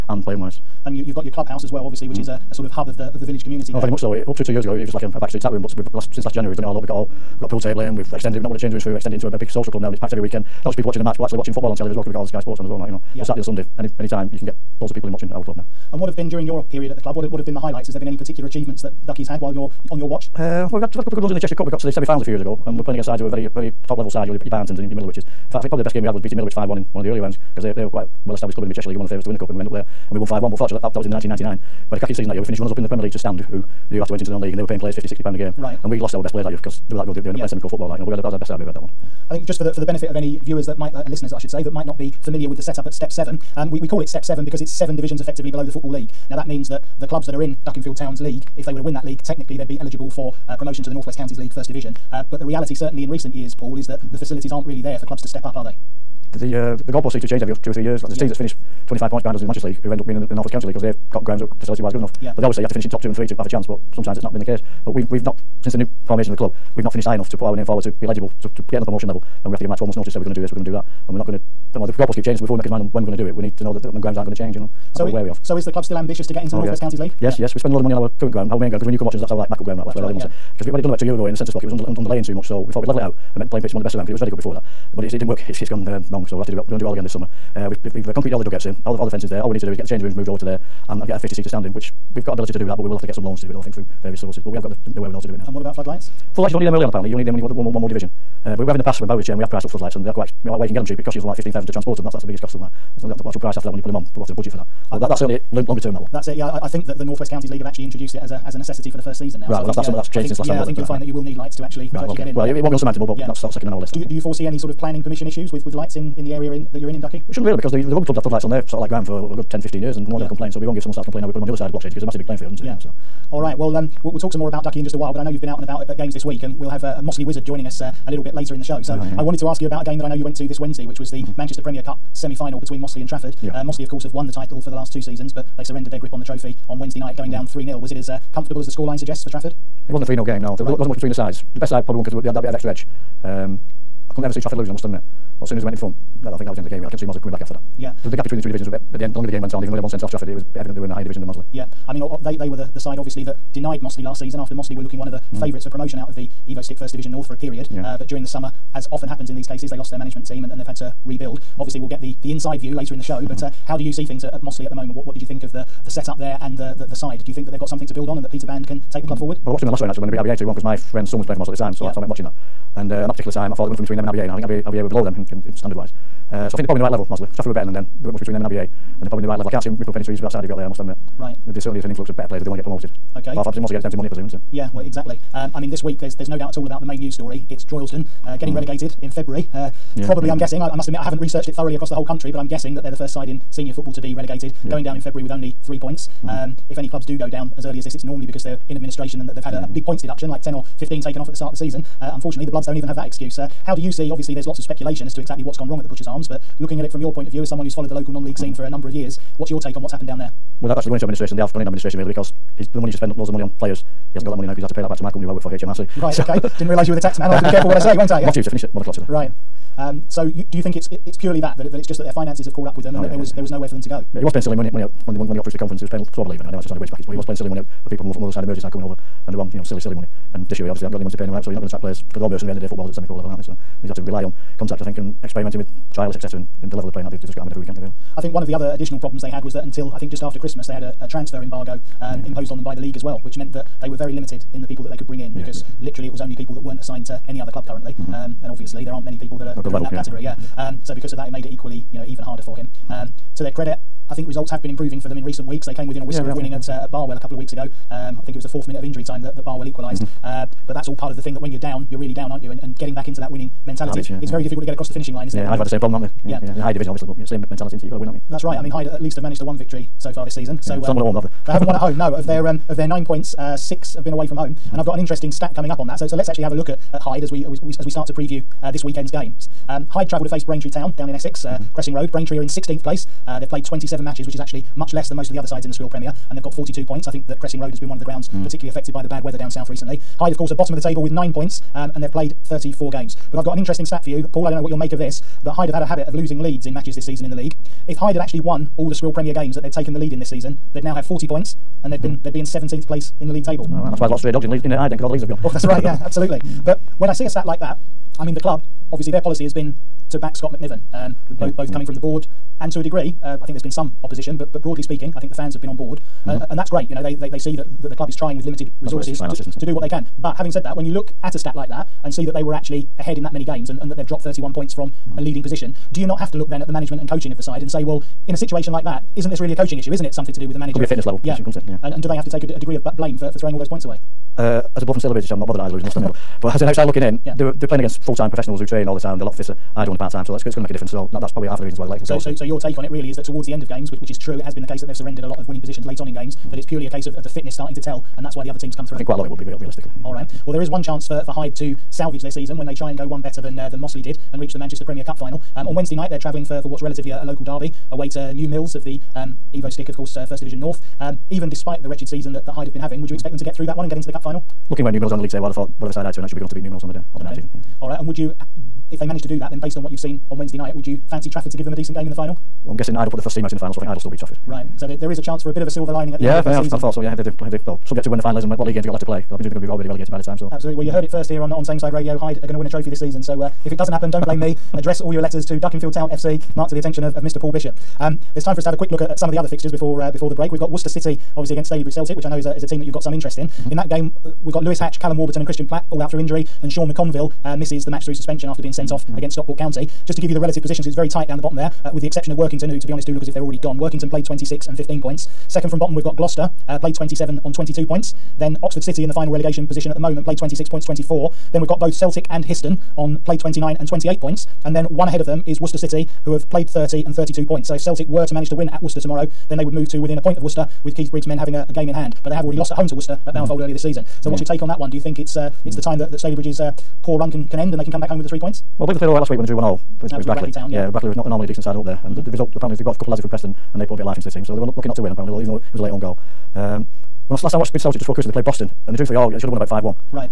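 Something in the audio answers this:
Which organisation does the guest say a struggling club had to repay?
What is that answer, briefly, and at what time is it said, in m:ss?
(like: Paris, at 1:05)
HMRC, at 3:35.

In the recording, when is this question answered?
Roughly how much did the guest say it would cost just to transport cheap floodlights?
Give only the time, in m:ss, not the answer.
1:41.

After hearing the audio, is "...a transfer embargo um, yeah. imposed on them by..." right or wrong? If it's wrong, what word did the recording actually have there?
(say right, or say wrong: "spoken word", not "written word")
right.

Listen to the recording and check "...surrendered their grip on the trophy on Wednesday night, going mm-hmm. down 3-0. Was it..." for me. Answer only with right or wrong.
right.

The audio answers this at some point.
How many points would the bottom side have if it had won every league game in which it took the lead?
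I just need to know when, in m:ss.
5:01.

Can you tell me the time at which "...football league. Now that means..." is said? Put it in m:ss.
0:45.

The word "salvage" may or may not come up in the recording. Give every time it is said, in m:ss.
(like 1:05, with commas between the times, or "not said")
5:51.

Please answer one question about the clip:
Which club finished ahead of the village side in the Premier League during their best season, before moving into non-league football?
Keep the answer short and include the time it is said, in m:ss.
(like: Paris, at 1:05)
Stand, at 0:33.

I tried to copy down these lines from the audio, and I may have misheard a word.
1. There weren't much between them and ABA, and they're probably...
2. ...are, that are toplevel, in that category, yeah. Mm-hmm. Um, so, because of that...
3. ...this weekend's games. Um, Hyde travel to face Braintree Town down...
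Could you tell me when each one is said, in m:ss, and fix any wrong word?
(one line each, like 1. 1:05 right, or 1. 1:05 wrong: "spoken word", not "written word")
1. 2:58 right
2. 4:09 wrong: "level", not "toplevel"
3. 4:38 right.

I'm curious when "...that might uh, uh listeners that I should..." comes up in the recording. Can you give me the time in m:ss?
0:40.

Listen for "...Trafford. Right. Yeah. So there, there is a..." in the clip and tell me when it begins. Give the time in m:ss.
6:14.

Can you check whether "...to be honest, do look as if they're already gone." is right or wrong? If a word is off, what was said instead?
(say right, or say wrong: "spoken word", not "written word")
right.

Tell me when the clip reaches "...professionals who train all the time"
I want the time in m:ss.
5:38.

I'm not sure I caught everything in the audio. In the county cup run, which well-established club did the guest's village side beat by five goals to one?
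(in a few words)
Middlewich.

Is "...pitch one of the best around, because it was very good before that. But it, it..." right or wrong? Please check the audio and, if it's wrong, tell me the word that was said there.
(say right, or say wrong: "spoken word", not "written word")
right.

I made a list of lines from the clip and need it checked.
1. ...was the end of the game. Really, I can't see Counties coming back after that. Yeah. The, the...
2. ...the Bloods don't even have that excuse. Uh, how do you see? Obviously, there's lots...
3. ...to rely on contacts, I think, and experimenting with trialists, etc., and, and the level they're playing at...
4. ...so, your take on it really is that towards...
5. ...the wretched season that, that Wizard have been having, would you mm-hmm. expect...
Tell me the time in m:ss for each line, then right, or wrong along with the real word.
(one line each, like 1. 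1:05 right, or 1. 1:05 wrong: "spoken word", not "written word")
1. 2:26 wrong: "Mossley", not "Counties"
2. 3:22 right
3. 3:53 right
4. 5:42 right
5. 6:01 wrong: "Hyde", not "Wizard".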